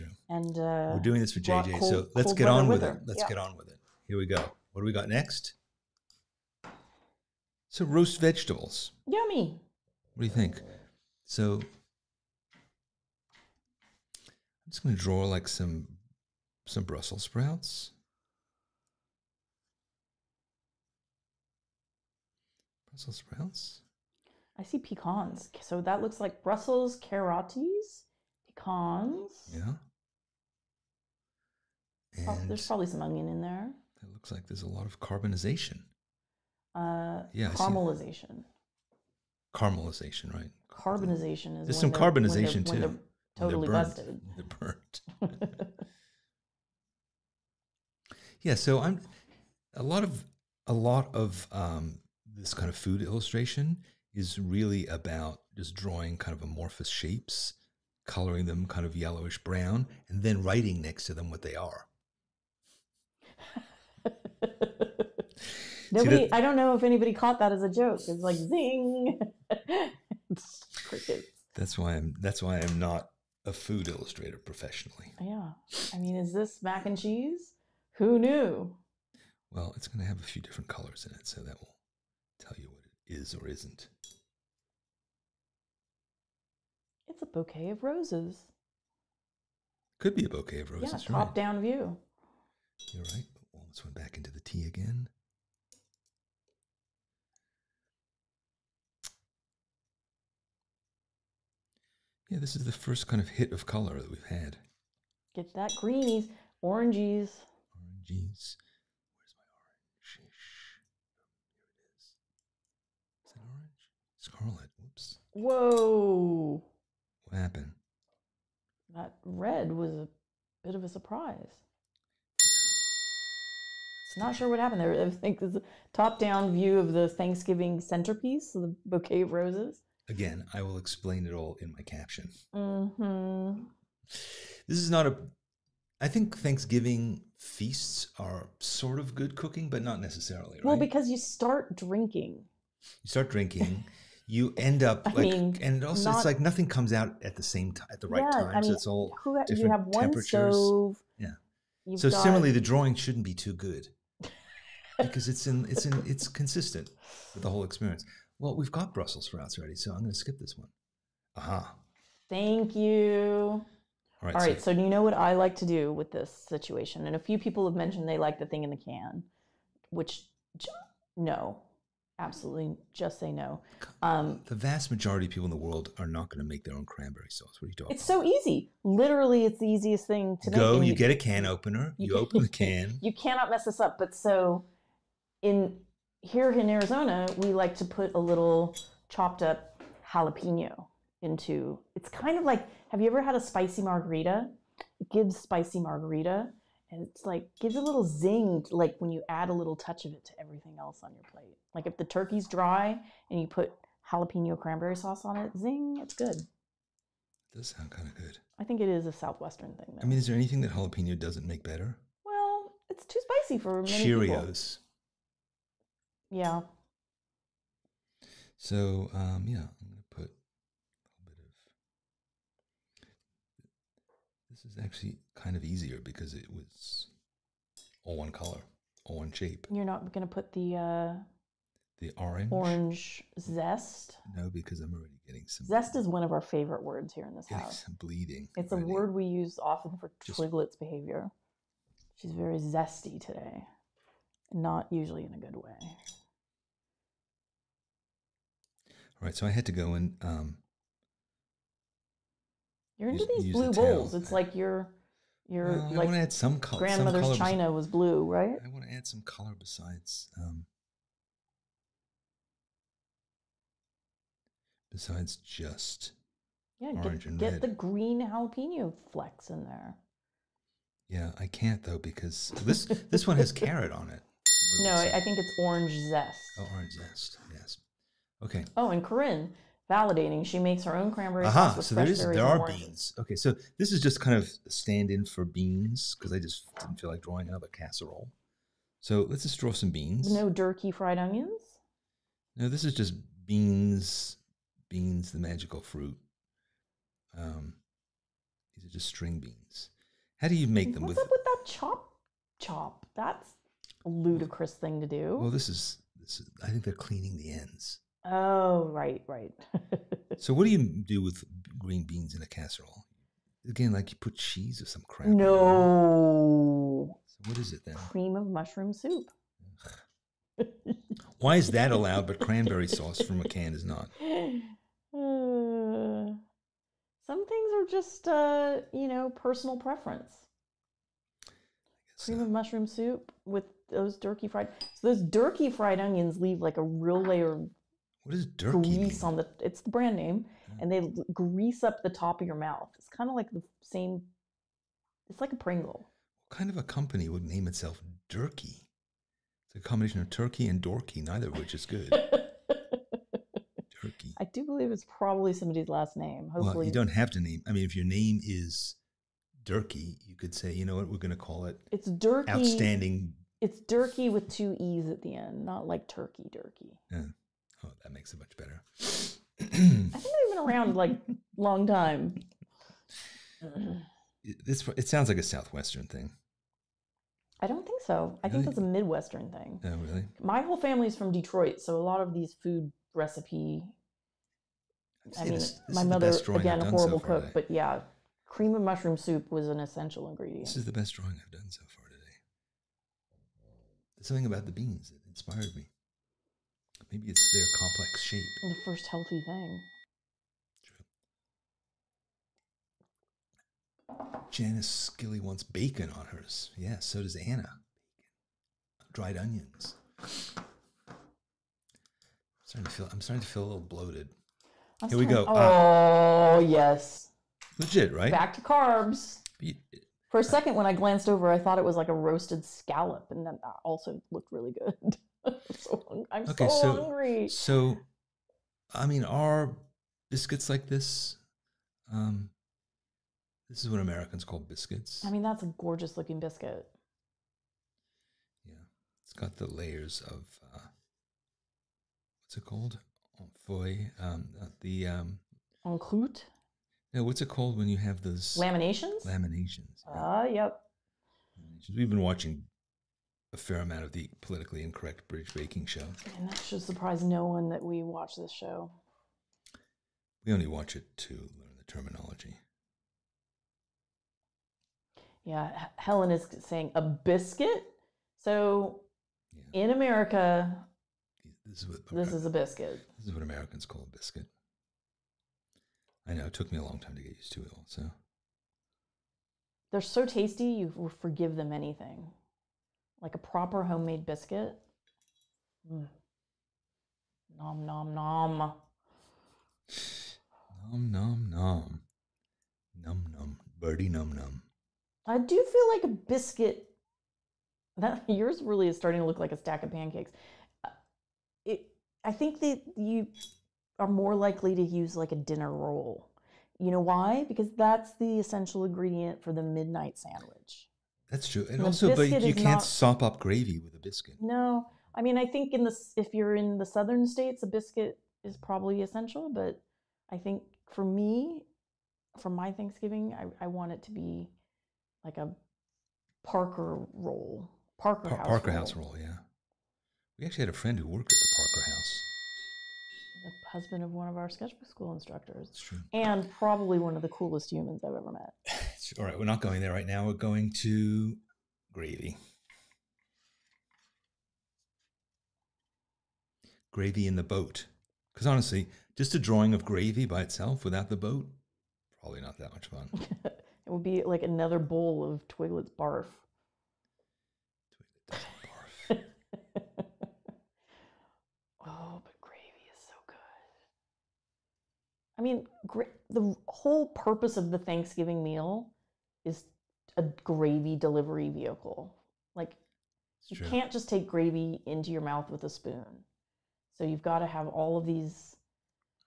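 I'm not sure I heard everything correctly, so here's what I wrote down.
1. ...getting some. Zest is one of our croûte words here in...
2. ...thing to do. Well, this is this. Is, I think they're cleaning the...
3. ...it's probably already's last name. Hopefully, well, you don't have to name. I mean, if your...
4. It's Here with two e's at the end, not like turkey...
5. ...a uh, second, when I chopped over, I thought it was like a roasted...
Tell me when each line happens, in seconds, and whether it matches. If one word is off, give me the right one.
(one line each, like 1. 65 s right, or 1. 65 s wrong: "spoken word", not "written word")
1. 235 s wrong: "favorite", not "croûte"
2. 304 s right
3. 354 s wrong: "somebody", not "already"
4. 363 s wrong: "Durkee", not "Here"
5. 420 s wrong: "glanced", not "chopped".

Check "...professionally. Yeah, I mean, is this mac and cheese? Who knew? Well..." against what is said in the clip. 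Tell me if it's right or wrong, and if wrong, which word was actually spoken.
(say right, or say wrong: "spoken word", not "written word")
right.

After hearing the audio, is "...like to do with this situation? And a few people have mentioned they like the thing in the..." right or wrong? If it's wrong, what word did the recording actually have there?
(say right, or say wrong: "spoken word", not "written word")
right.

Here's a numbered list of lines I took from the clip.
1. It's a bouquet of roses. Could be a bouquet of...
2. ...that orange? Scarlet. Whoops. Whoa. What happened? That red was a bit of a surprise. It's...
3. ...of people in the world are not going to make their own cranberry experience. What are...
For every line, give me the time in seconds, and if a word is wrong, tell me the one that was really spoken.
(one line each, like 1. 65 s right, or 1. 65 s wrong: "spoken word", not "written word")
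1. 87 s right
2. 114 s right
3. 175 s wrong: "sauce", not "experience".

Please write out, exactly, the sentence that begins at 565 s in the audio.
I mean, the whole purpose of the Thanksgiving meal is a gravy delivery vehicle.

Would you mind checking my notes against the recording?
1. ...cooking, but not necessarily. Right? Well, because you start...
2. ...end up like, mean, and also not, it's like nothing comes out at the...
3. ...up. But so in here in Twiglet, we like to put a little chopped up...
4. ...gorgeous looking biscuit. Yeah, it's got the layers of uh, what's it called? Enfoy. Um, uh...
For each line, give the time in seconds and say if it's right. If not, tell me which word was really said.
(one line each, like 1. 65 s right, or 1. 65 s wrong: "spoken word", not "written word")
1. 139 s right
2. 144 s right
3. 183 s wrong: "Arizona", not "Twiglet"
4. 435 s right.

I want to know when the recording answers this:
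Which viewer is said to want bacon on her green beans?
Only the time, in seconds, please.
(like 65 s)
404 s.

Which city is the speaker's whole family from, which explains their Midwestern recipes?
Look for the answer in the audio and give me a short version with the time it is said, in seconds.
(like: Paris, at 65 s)
Detroit, at 381 s.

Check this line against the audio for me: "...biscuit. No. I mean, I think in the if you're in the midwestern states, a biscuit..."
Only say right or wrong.
wrong.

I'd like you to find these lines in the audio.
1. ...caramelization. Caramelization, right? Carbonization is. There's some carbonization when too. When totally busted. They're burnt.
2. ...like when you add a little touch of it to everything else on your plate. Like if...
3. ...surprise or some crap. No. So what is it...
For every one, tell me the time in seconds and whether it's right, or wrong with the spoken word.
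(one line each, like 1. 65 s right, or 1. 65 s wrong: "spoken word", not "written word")
1. 37 s right
2. 198 s right
3. 314 s wrong: "cheese", not "surprise".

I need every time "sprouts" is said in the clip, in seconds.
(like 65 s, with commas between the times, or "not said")
17 s, 23 s, 159 s.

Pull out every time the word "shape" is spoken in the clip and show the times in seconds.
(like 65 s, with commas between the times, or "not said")
56 s, 229 s, 398 s.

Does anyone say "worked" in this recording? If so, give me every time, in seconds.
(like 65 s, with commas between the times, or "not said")
531 s.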